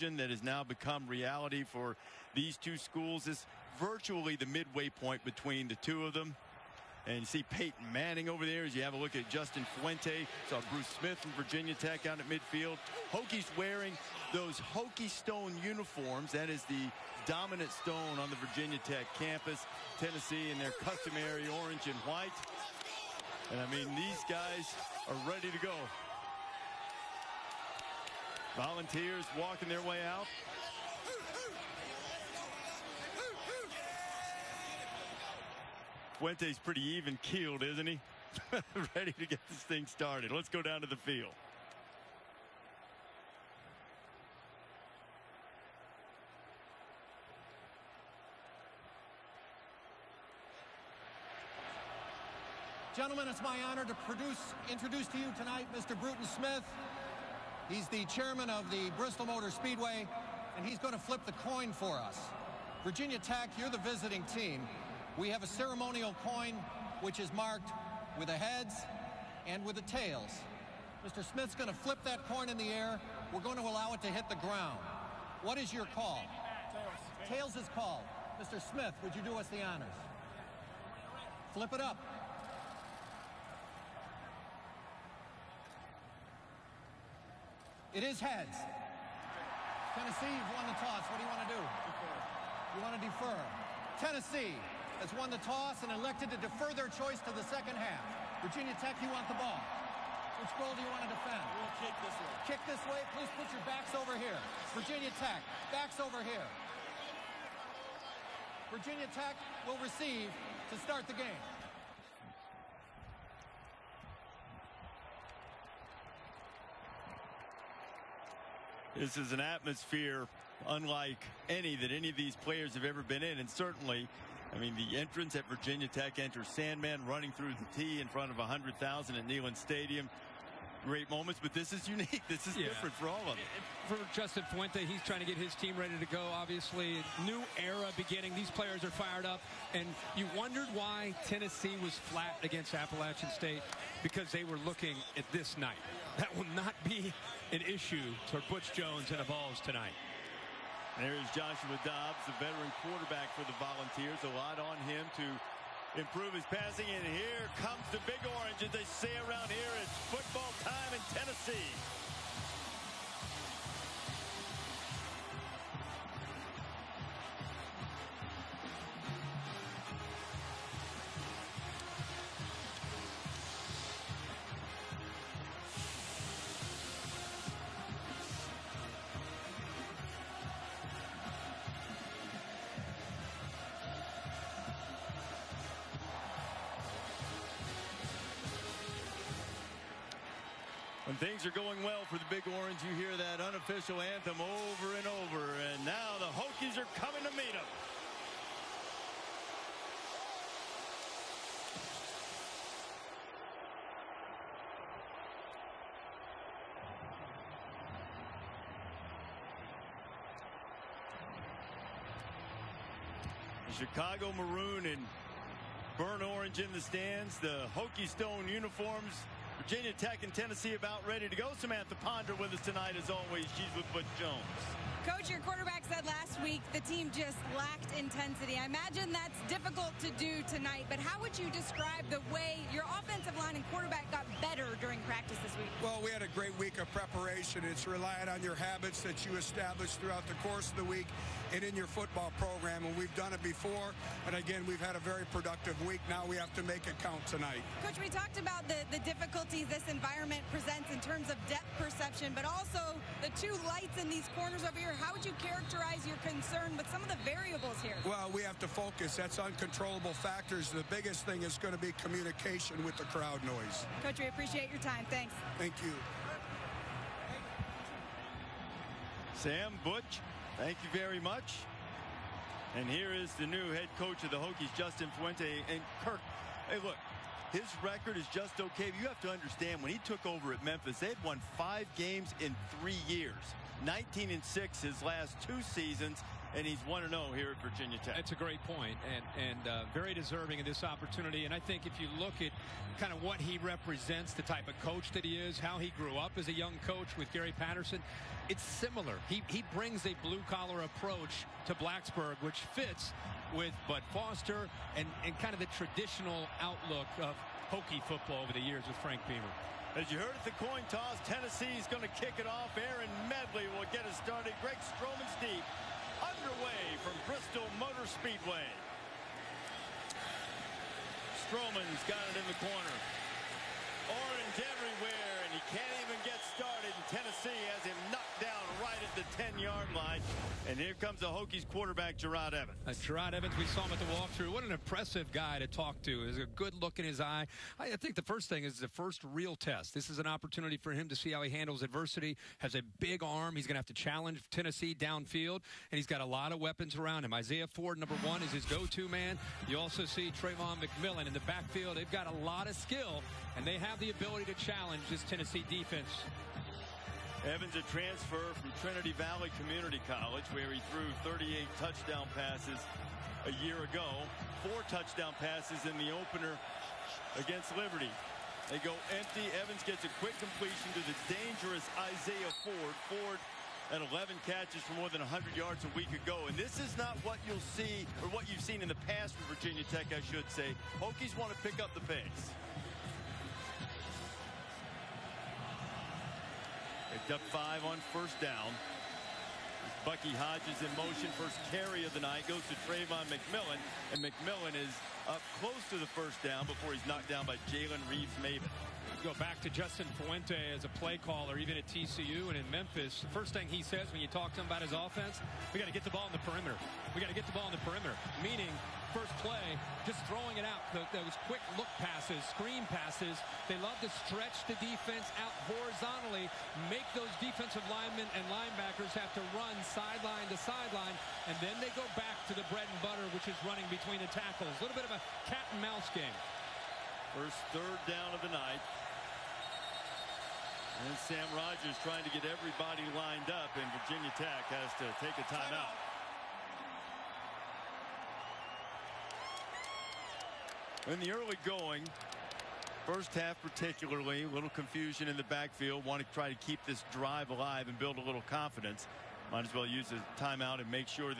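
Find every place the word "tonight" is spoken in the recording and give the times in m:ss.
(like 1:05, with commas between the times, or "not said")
0:55, 2:29, 3:42, 3:50, 4:07.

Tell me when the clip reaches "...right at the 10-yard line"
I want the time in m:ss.
5:28.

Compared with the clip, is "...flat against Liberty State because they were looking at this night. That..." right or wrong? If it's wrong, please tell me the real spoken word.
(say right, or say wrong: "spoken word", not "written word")
wrong: "Appalachian", not "Liberty".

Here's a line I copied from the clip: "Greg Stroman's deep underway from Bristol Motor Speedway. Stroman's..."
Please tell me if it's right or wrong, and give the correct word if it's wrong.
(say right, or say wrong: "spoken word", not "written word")
right.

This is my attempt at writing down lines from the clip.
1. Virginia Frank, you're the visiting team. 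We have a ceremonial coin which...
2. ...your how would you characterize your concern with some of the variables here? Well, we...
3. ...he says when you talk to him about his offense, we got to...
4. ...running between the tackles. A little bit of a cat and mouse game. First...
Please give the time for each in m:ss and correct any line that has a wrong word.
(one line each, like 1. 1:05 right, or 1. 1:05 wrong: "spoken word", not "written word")
1. 1:02 wrong: "Tech", not "Frank"
2. 4:14 right
3. 6:43 right
4. 7:03 right.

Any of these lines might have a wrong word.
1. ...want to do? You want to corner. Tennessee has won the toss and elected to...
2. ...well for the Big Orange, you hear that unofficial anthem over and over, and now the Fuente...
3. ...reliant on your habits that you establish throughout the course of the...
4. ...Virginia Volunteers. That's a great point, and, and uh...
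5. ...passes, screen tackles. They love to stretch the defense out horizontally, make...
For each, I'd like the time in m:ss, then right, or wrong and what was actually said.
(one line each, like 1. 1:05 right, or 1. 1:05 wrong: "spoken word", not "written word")
1. 1:31 wrong: "defer", not "corner"
2. 3:11 wrong: "Hokies", not "Fuente"
3. 3:57 right
4. 4:47 wrong: "Tech", not "Volunteers"
5. 6:52 wrong: "passes", not "tackles".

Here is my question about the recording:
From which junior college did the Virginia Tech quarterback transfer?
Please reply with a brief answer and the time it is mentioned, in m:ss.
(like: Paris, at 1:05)
Trinity Valley Community College, at 5:58.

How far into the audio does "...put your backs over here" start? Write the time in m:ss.
1:43.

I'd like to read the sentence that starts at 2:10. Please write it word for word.
Great moments, but this is unique.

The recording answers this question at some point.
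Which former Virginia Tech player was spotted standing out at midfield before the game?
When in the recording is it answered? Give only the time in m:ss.
0:10.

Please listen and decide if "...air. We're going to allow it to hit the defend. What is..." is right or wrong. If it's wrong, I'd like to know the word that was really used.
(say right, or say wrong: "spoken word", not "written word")
wrong: "ground", not "defend".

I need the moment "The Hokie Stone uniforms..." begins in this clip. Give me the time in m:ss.
3:37.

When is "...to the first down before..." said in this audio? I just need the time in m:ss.
6:35.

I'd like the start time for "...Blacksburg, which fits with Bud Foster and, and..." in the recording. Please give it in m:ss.
5:01.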